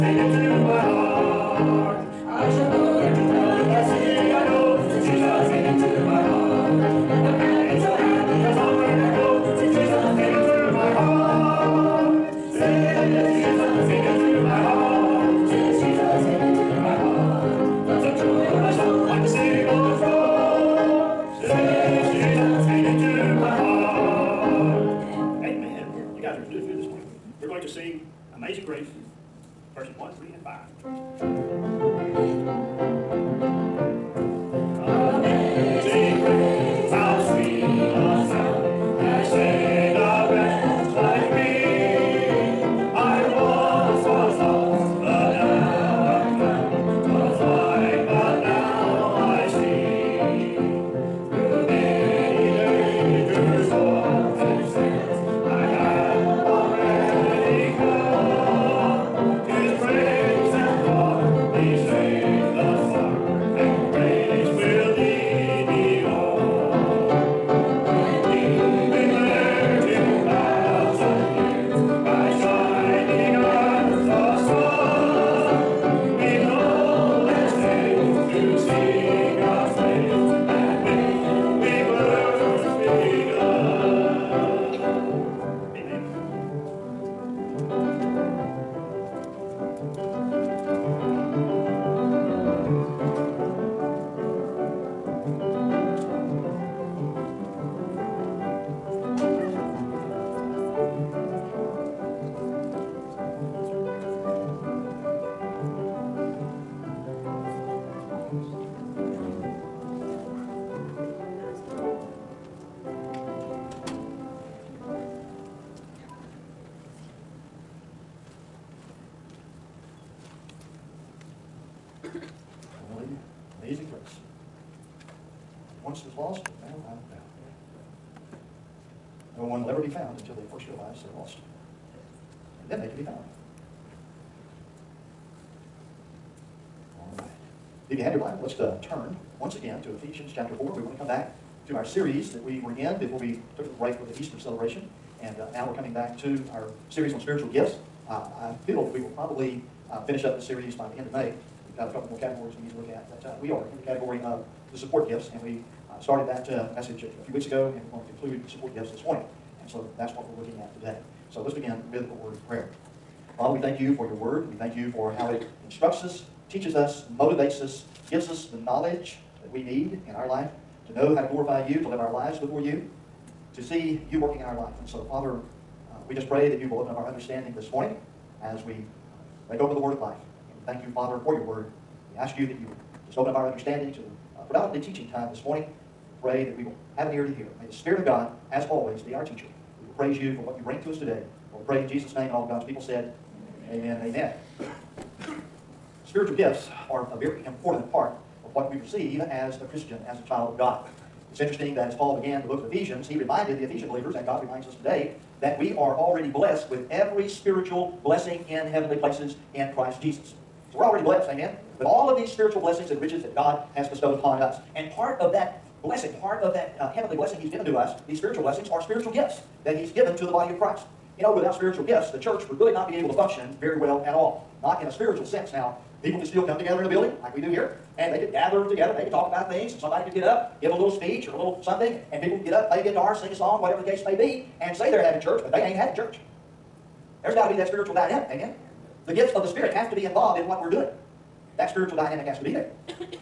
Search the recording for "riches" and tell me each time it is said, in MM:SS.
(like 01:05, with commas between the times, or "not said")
03:33.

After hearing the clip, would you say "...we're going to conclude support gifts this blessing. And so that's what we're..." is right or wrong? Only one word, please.
wrong.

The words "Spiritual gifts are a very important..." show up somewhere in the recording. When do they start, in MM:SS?
03:16.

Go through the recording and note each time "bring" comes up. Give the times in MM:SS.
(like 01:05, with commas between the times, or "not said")
03:10.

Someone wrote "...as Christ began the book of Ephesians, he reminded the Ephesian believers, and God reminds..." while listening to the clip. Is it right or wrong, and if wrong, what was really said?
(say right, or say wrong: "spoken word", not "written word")
wrong: "Paul", not "Christ".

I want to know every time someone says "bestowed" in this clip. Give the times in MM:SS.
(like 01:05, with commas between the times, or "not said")
03:33.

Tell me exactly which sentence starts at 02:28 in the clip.
Uh, I feel that we will probably uh, finish up this series by the end of May.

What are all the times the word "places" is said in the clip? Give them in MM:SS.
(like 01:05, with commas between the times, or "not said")
03:29.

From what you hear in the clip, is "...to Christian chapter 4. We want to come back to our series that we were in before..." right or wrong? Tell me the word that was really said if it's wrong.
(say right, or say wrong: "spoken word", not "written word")
wrong: "Ephesians", not "Christian".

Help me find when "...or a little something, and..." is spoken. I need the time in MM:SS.
03:51.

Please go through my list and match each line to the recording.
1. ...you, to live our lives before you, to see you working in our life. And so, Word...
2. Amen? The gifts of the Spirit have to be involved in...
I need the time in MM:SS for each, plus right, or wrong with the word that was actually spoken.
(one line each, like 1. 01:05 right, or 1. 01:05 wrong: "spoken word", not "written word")
1. 02:51 wrong: "Father", not "Word"
2. 03:58 right.